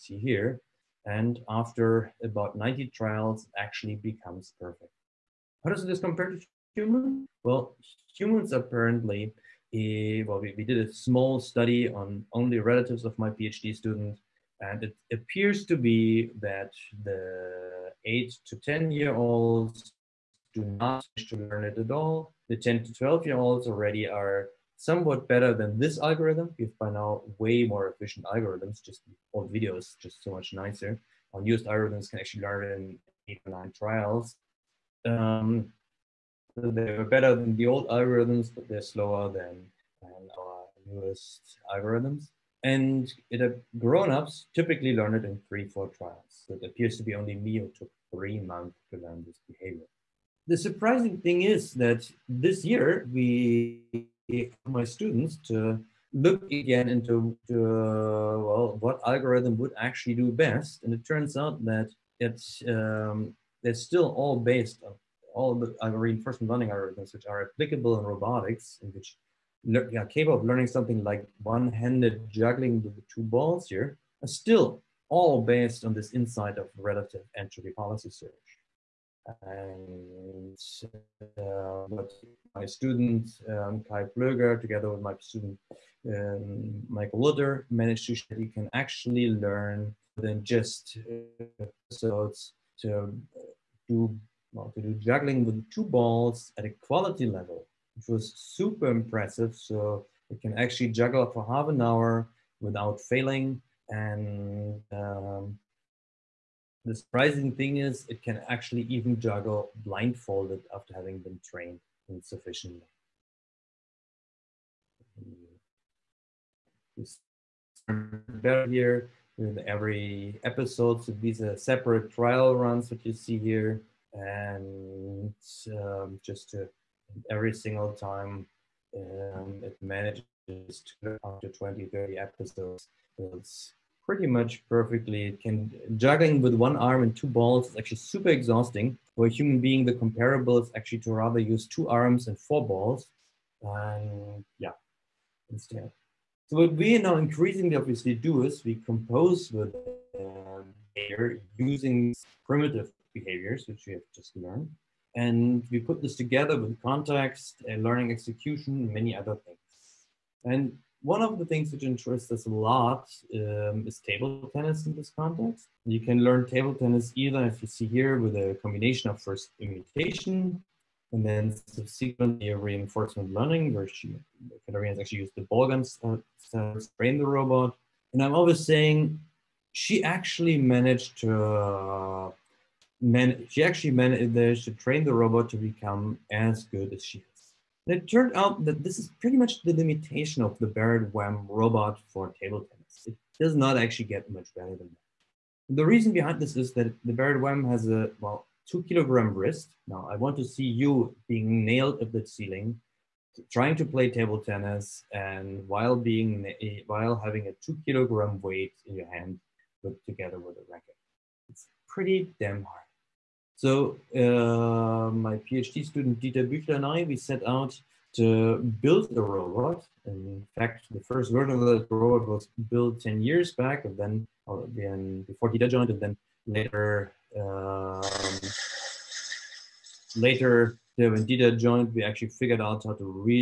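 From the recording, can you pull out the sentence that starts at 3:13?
It does not actually get much better than that.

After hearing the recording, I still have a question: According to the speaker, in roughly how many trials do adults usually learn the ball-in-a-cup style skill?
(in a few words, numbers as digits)
3 or 4 trials.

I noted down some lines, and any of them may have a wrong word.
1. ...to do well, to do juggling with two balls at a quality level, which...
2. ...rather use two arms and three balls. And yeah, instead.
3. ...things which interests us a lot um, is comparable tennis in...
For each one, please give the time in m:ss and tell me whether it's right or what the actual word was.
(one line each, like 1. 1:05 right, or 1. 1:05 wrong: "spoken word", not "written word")
1. 1:32 right
2. 2:21 wrong: "four", not "three"
3. 2:41 wrong: "table", not "comparable".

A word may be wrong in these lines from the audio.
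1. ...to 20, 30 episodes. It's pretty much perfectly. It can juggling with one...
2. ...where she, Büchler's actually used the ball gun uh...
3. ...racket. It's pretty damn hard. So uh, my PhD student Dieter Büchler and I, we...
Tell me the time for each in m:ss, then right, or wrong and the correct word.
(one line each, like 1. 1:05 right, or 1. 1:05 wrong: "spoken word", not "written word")
1. 2:11 right
2. 2:53 wrong: "Katarina", not "Büchler"
3. 3:30 right.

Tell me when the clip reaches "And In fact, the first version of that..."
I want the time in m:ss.
3:40.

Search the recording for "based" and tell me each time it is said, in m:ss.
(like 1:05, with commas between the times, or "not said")
1:04, 1:15.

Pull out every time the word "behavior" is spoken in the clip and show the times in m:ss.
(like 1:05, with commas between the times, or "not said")
0:49, 2:33.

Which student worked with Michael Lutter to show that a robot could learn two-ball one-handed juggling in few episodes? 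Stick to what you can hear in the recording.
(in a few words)
Kai Plöger.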